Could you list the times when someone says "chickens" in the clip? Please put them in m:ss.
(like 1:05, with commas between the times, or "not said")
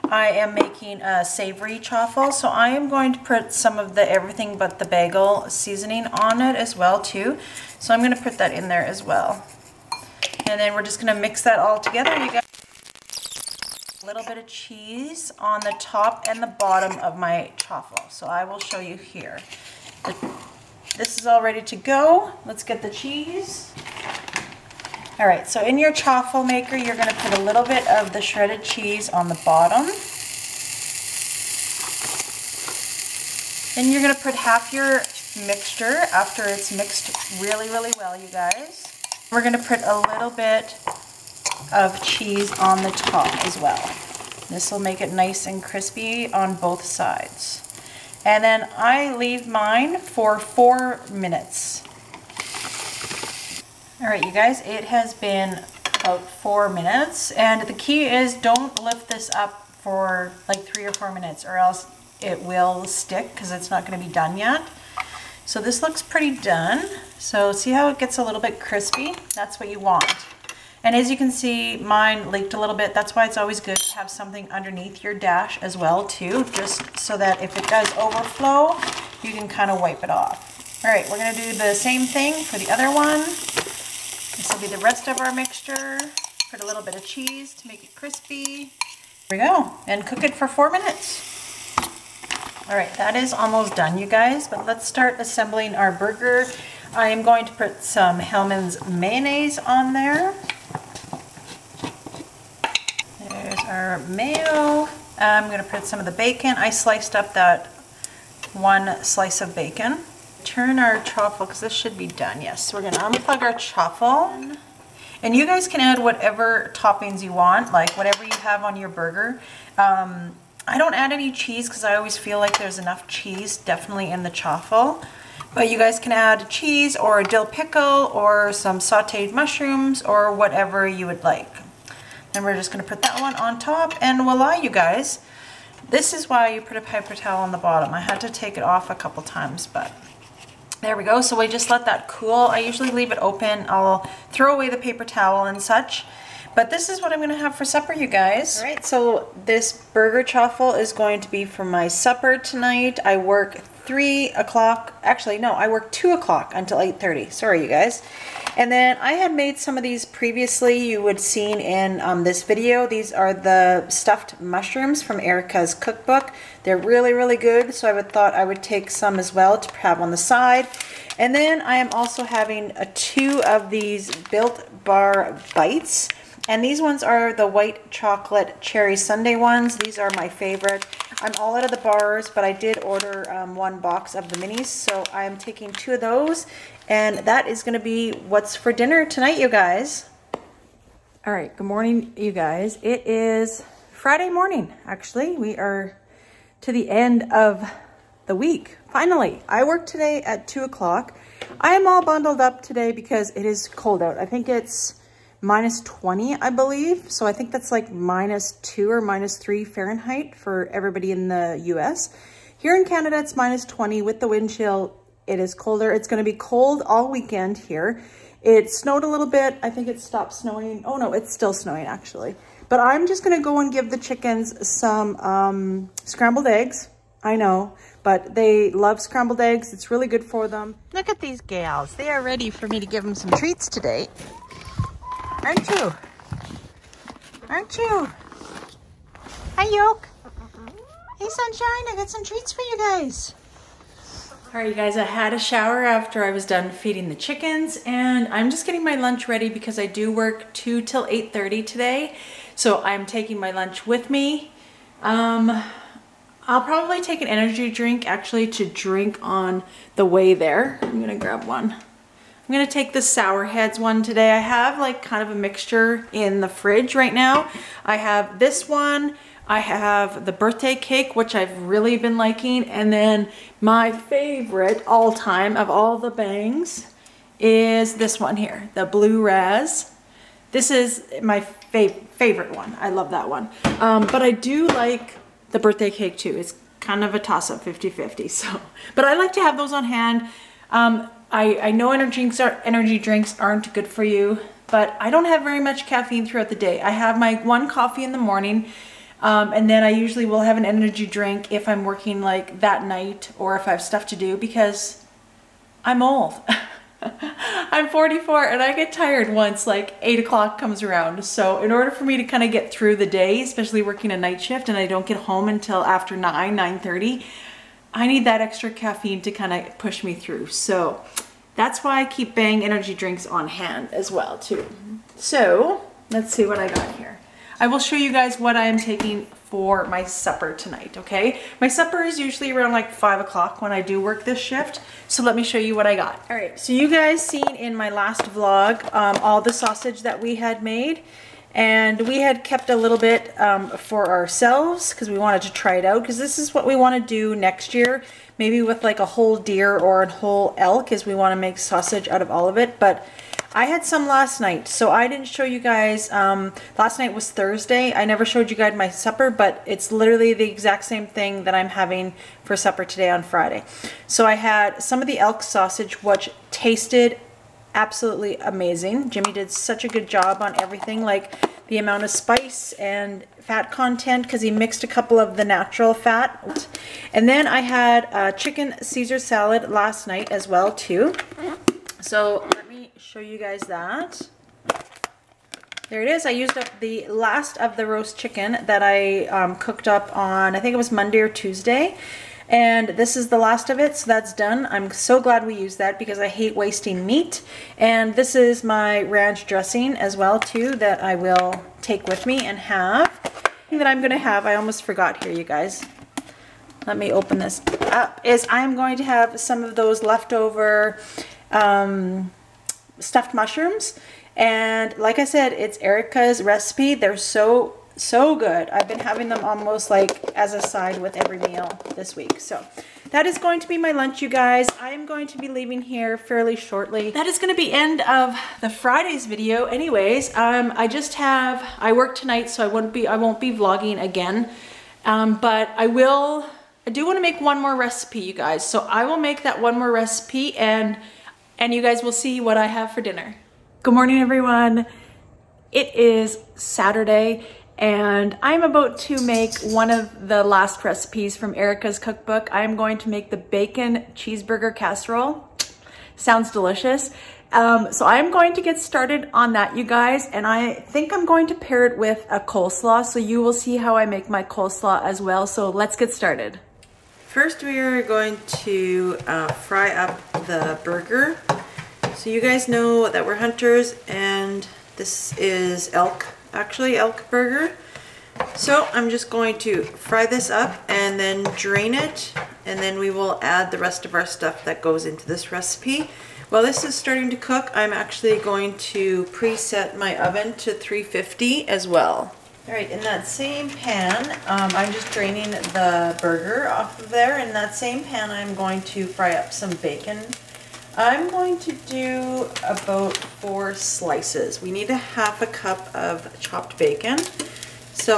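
3:43, 4:07, 6:18, 6:28.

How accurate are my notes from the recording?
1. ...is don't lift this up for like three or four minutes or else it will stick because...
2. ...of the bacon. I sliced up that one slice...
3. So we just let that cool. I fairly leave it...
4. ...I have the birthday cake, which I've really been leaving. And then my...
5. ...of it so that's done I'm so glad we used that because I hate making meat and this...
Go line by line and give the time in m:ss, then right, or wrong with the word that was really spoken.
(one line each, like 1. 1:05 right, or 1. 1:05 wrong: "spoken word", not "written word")
1. 0:58 right
2. 1:45 right
3. 2:21 wrong: "usually", not "fairly"
4. 4:29 wrong: "liking", not "leaving"
5. 6:33 wrong: "wasting", not "making".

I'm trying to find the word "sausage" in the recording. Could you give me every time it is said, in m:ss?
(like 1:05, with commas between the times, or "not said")
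5:39, 5:51, 6:05.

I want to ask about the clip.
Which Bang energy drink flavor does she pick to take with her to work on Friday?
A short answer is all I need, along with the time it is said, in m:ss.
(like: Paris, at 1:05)
Sour Heads, at 4:23.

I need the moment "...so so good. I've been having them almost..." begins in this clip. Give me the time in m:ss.
6:57.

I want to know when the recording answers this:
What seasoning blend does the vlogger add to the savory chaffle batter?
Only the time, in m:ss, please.
0:04.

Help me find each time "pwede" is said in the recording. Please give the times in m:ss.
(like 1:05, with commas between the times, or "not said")
not said.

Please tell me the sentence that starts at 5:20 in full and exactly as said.
So that's why I keep Bang energy drinks on hand as well too.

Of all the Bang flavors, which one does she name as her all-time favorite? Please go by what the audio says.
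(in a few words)
Blue Raz.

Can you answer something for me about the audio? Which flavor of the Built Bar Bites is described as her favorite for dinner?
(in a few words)
white chocolate cherry sundae.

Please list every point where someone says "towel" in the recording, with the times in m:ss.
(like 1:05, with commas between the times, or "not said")
2:17, 2:25.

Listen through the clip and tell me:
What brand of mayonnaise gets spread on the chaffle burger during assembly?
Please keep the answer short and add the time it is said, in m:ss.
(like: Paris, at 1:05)
Hellmann's, at 1:38.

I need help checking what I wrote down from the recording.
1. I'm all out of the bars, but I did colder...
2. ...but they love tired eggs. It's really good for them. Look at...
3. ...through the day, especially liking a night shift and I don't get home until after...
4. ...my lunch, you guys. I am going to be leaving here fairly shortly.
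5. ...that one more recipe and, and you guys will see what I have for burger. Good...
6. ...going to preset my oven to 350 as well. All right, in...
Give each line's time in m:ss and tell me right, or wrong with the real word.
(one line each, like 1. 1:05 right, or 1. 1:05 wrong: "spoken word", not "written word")
1. 3:01 wrong: "order", not "colder"
2. 3:48 wrong: "scrambled", not "tired"
3. 5:12 wrong: "working", not "liking"
4. 7:03 right
5. 7:19 wrong: "dinner", not "burger"
6. 8:08 right.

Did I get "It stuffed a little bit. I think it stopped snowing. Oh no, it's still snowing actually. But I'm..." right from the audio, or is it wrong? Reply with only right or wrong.
wrong.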